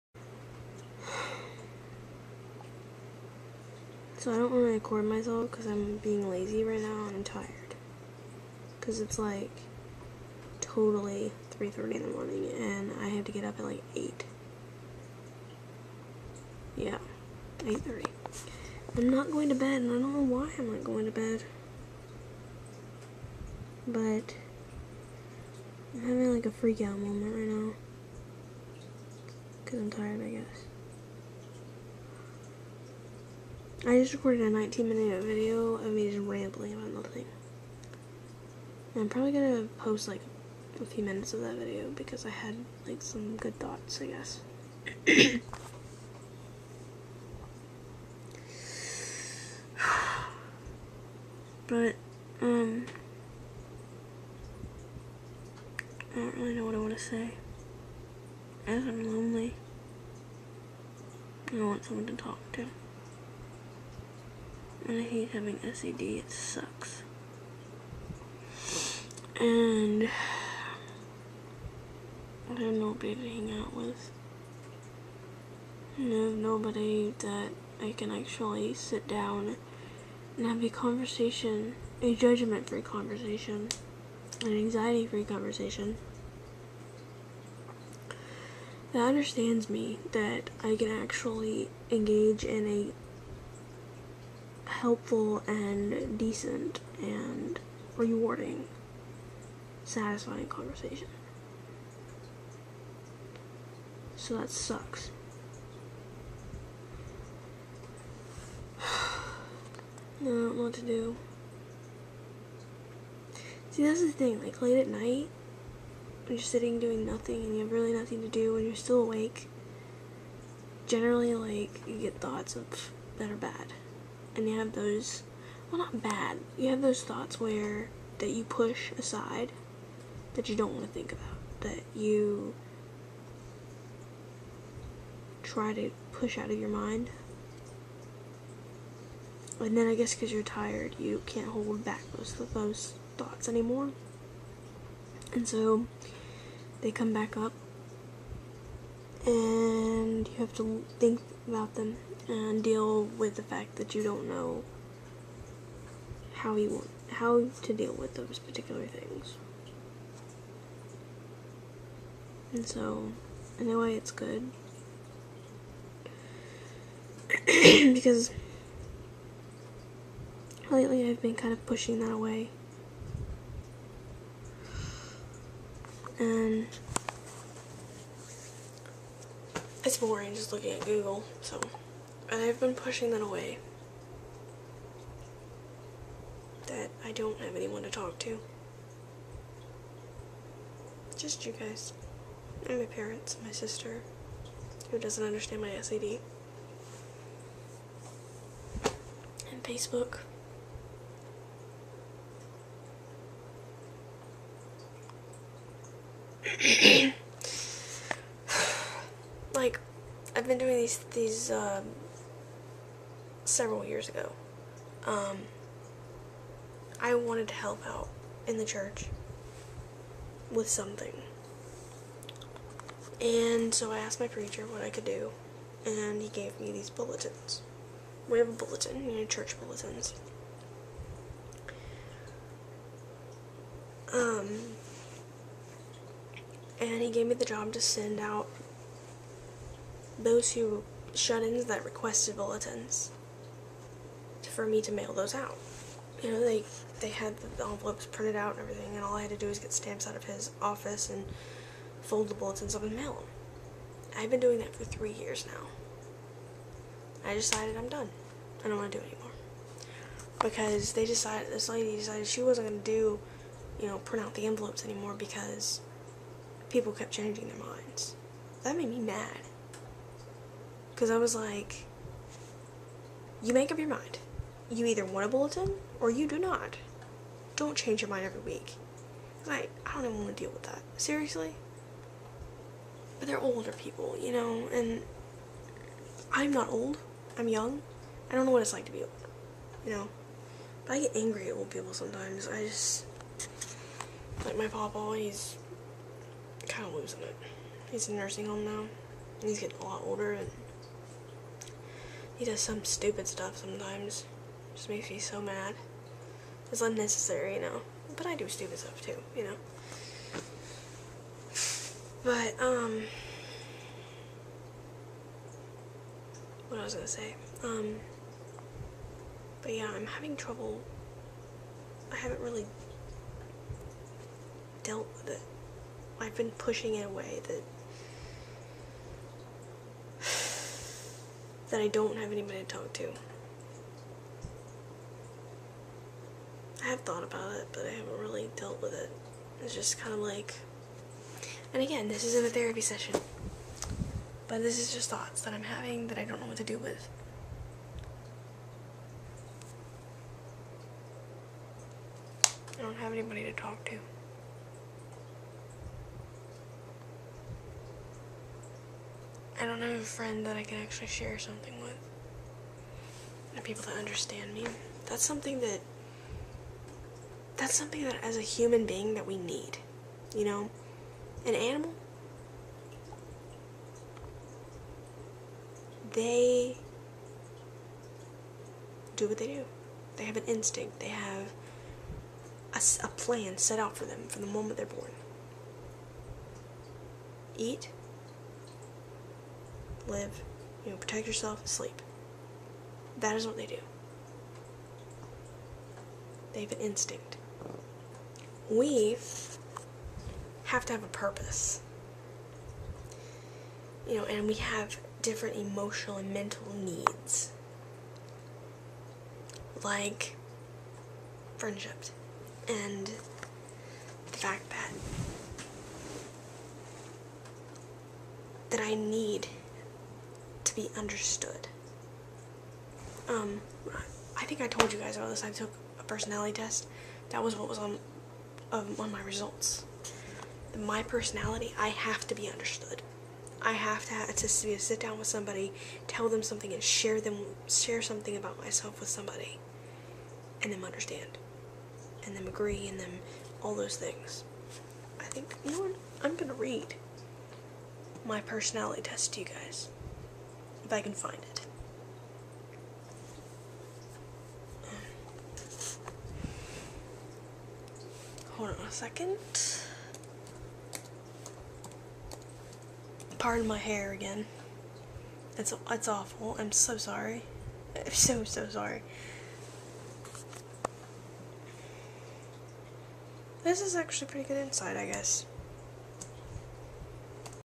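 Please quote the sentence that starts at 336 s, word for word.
I have thought about it, but I haven't really dealt with it.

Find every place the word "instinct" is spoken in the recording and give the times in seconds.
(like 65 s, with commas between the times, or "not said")
380 s, 396 s.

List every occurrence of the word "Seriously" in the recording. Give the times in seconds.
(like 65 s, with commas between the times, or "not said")
280 s.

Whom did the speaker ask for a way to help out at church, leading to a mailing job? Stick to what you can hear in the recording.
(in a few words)
preacher.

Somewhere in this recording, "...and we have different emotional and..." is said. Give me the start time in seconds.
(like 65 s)
404 s.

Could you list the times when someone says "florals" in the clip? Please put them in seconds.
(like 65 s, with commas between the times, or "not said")
not said.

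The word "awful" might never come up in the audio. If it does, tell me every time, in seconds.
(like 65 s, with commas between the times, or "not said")
466 s.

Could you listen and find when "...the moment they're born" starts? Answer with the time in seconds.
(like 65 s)
384 s.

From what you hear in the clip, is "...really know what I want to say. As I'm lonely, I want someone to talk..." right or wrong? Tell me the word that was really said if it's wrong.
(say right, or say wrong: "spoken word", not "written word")
right.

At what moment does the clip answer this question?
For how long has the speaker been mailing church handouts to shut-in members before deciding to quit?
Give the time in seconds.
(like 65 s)
254 s.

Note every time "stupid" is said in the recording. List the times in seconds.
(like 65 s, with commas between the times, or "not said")
302 s, 308 s.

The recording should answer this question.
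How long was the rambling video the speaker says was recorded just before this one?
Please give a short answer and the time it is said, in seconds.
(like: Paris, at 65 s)
19 minutes, at 34 s.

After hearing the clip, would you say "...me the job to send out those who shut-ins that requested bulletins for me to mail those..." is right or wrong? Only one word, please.
right.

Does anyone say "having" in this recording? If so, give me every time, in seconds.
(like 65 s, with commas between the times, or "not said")
26 s, 65 s, 320 s, 345 s.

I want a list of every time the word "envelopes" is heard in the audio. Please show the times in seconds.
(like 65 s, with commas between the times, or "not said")
247 s, 264 s.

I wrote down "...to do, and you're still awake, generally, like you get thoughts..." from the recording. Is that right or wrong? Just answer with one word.
right.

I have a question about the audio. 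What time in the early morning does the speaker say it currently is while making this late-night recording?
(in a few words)
3:30.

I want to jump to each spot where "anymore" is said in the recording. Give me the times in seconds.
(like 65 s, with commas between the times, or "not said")
143 s, 259 s, 264 s.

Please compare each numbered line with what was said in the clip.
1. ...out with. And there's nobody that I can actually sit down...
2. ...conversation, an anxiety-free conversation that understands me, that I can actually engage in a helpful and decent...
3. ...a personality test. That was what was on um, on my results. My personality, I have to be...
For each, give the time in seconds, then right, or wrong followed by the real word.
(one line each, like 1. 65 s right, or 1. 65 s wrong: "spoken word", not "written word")
1. 73 s right
2. 82 s right
3. 425 s right.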